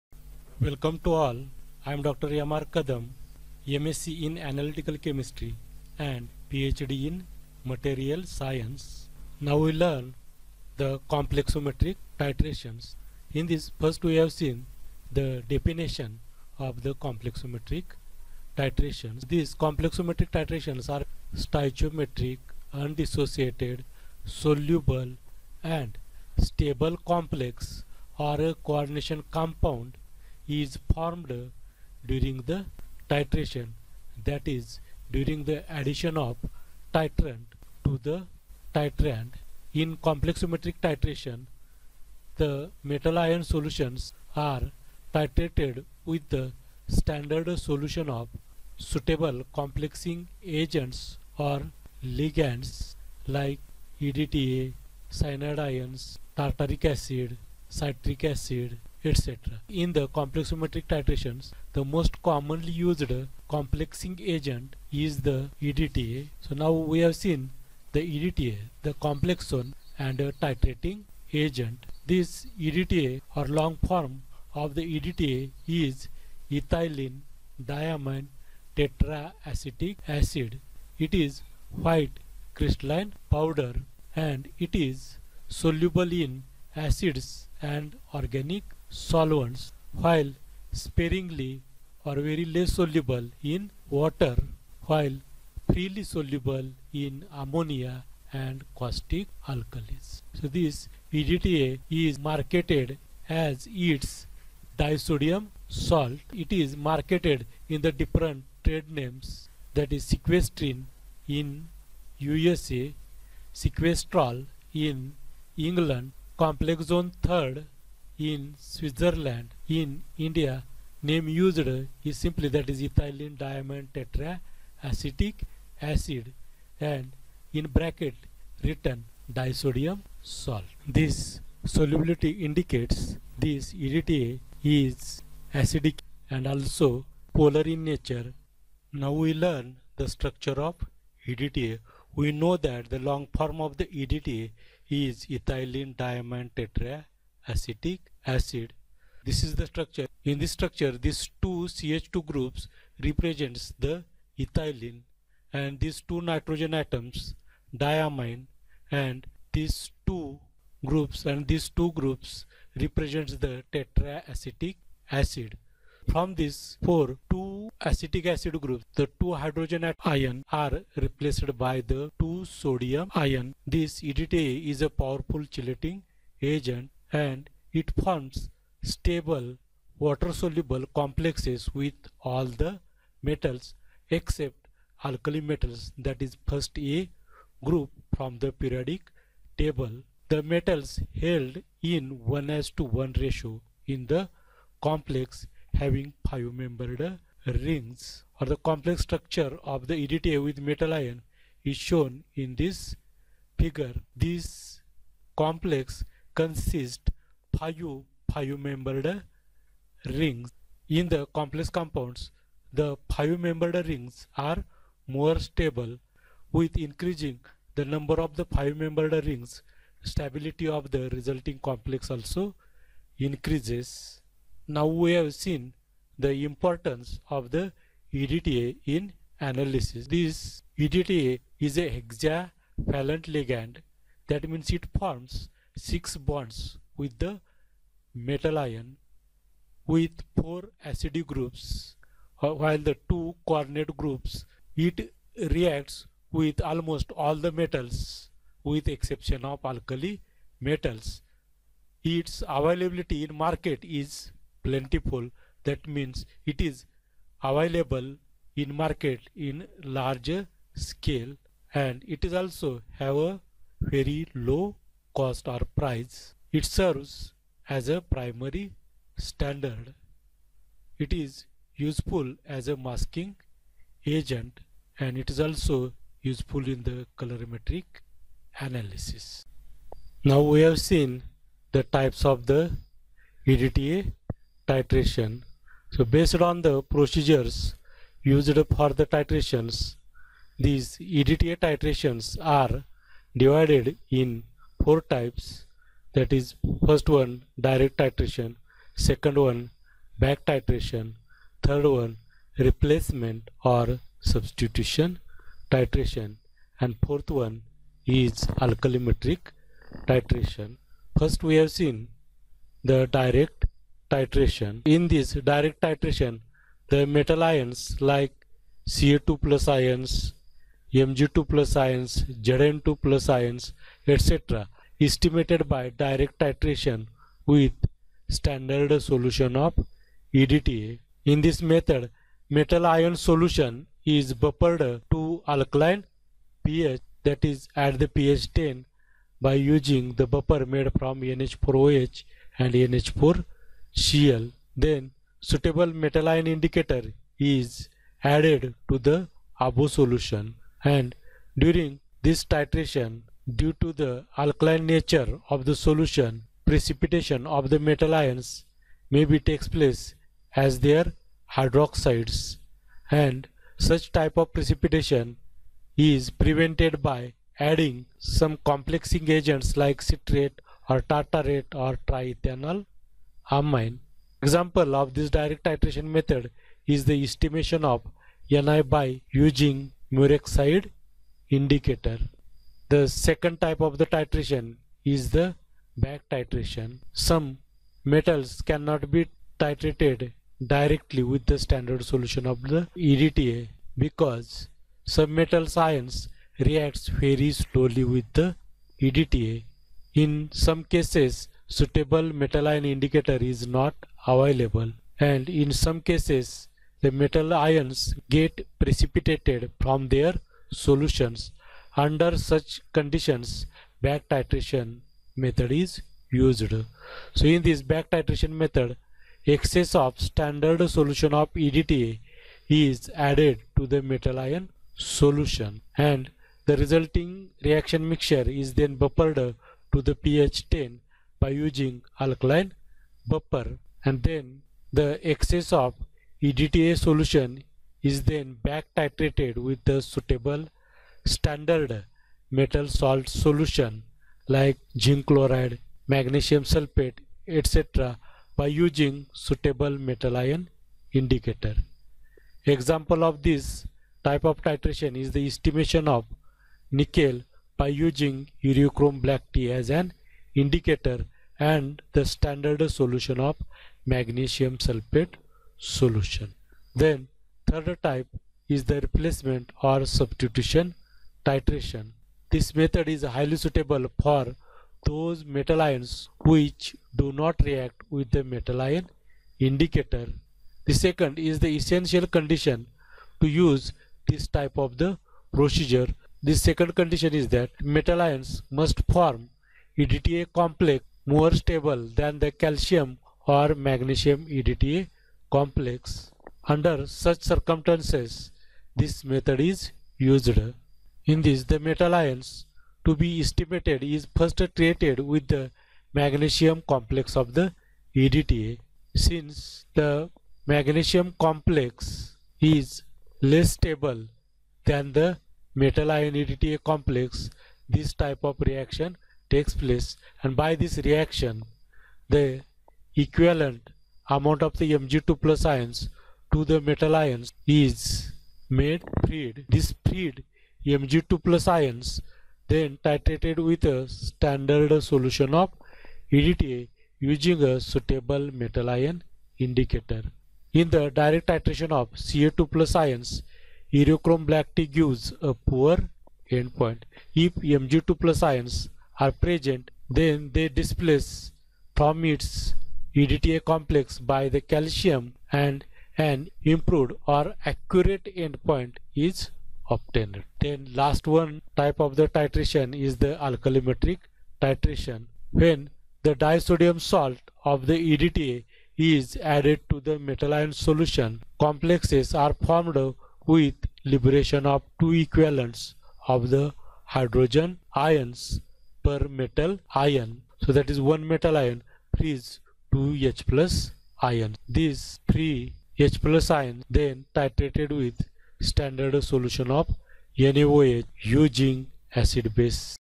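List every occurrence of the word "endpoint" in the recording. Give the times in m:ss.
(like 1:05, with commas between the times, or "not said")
9:06, 9:18.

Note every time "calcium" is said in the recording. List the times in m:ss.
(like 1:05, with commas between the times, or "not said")
8:12, 9:14.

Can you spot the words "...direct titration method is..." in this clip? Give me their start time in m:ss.
6:15.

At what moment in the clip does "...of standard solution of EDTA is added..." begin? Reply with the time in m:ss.
6:59.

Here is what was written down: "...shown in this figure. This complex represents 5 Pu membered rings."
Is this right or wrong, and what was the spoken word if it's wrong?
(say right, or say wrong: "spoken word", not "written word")
wrong: "consists", not "represents".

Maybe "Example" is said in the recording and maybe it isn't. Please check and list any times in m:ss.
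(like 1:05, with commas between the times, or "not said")
6:14, 7:32.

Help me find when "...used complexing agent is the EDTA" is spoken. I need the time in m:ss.
1:02.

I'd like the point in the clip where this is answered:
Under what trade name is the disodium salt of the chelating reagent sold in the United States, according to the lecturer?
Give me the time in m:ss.
1:50.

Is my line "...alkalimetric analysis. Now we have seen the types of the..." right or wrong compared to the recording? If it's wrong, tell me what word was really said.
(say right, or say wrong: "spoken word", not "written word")
wrong: "colorimetric", not "alkalimetric".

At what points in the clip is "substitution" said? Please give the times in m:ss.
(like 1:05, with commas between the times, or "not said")
5:04, 7:50.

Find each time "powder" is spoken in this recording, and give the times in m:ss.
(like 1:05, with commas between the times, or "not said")
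1:23.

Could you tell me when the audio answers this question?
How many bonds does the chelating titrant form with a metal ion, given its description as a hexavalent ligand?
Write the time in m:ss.
3:55.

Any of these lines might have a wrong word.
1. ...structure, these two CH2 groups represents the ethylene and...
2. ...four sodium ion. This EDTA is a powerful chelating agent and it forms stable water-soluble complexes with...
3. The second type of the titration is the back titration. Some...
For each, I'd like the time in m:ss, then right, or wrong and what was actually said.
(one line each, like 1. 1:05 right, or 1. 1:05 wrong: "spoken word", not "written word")
1. 2:30 right
2. 2:52 wrong: "two", not "four"
3. 6:22 right.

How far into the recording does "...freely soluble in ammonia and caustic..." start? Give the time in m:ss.
1:35.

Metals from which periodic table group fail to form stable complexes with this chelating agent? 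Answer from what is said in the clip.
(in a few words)
first A group.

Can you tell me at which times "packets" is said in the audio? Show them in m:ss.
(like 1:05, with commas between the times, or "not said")
not said.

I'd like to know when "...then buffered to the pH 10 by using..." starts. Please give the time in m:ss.
7:08.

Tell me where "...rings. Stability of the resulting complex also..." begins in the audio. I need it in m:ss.
3:39.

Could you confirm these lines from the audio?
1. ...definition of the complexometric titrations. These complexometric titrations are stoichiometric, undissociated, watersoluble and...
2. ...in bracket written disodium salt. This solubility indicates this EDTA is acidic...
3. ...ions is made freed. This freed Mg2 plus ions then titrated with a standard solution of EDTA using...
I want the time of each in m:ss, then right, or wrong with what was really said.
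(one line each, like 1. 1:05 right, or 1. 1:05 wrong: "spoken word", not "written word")
1. 0:15 wrong: "soluble", not "watersoluble"
2. 2:07 right
3. 8:47 right.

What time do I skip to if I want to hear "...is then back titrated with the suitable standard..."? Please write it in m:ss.
7:18.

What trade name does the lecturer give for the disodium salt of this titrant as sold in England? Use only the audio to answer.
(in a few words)
Sequestrol.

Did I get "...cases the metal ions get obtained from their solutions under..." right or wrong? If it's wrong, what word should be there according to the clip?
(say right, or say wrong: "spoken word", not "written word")
wrong: "precipitated", not "obtained".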